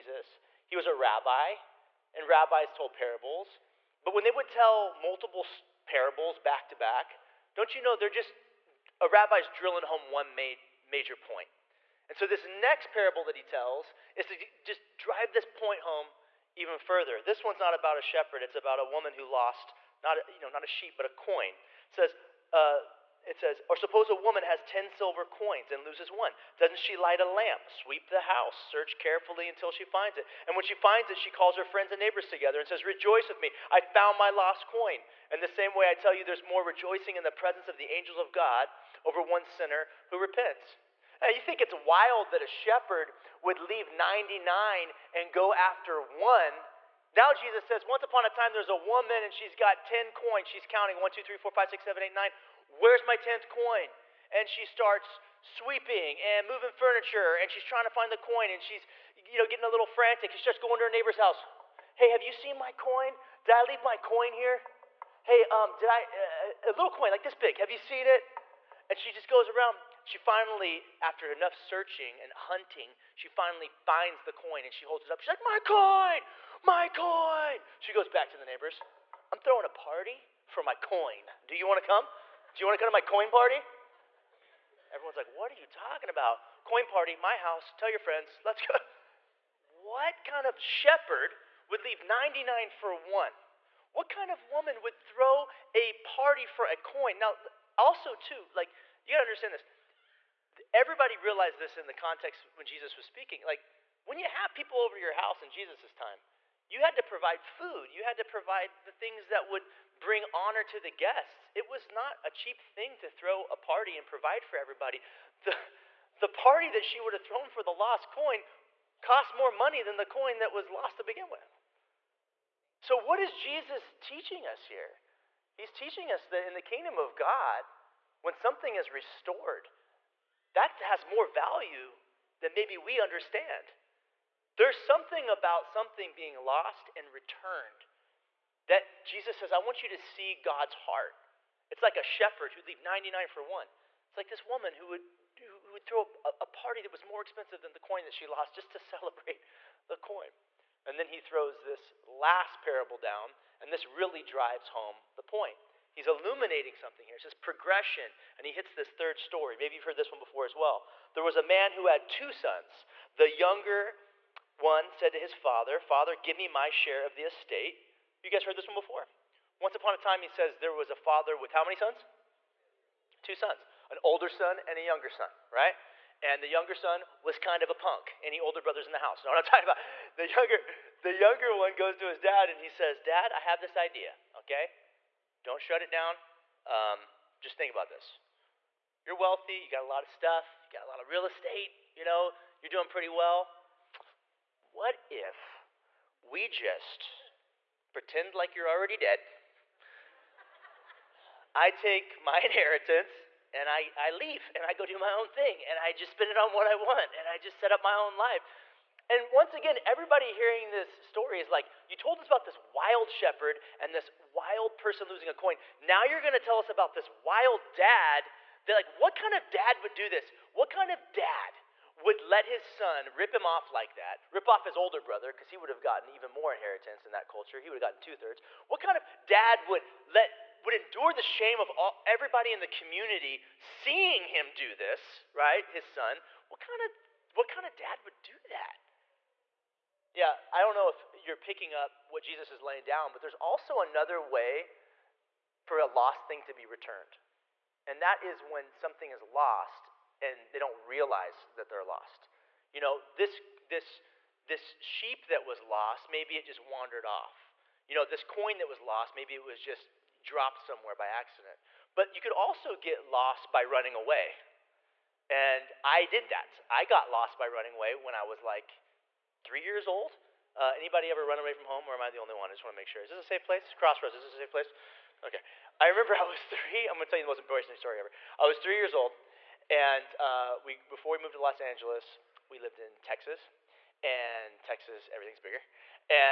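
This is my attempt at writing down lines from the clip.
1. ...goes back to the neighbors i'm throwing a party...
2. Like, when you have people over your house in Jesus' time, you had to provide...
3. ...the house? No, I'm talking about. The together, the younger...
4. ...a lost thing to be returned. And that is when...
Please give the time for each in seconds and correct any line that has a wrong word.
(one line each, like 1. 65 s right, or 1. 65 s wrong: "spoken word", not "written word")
1. 77 s right
2. 103 s right
3. 178 s wrong: "younger", not "together"
4. 245 s right.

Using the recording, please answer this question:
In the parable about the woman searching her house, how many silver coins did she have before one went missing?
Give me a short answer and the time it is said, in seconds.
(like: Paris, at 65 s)
10, at 24 s.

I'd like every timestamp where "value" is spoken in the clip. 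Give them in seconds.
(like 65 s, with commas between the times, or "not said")
131 s.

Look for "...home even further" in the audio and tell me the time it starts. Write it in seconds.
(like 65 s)
15 s.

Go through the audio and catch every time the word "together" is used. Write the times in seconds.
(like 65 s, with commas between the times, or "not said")
32 s.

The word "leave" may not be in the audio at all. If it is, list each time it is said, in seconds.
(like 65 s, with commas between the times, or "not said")
43 s, 63 s, 91 s, 142 s, 204 s.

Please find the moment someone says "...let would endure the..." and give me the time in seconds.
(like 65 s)
230 s.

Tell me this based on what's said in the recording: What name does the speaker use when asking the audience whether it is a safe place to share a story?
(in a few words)
Crossroads.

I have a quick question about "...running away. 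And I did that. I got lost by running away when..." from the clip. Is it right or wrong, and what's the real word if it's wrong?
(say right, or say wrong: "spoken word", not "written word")
right.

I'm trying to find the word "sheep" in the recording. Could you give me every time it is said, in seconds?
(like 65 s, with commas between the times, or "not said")
20 s, 254 s.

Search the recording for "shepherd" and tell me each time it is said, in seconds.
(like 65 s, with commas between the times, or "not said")
18 s, 42 s, 90 s, 142 s, 213 s.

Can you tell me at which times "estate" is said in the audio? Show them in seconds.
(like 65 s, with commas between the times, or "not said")
167 s, 191 s.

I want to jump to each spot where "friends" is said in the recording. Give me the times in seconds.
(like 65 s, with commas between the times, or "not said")
31 s, 87 s.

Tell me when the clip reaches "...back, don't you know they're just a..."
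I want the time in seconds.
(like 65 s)
6 s.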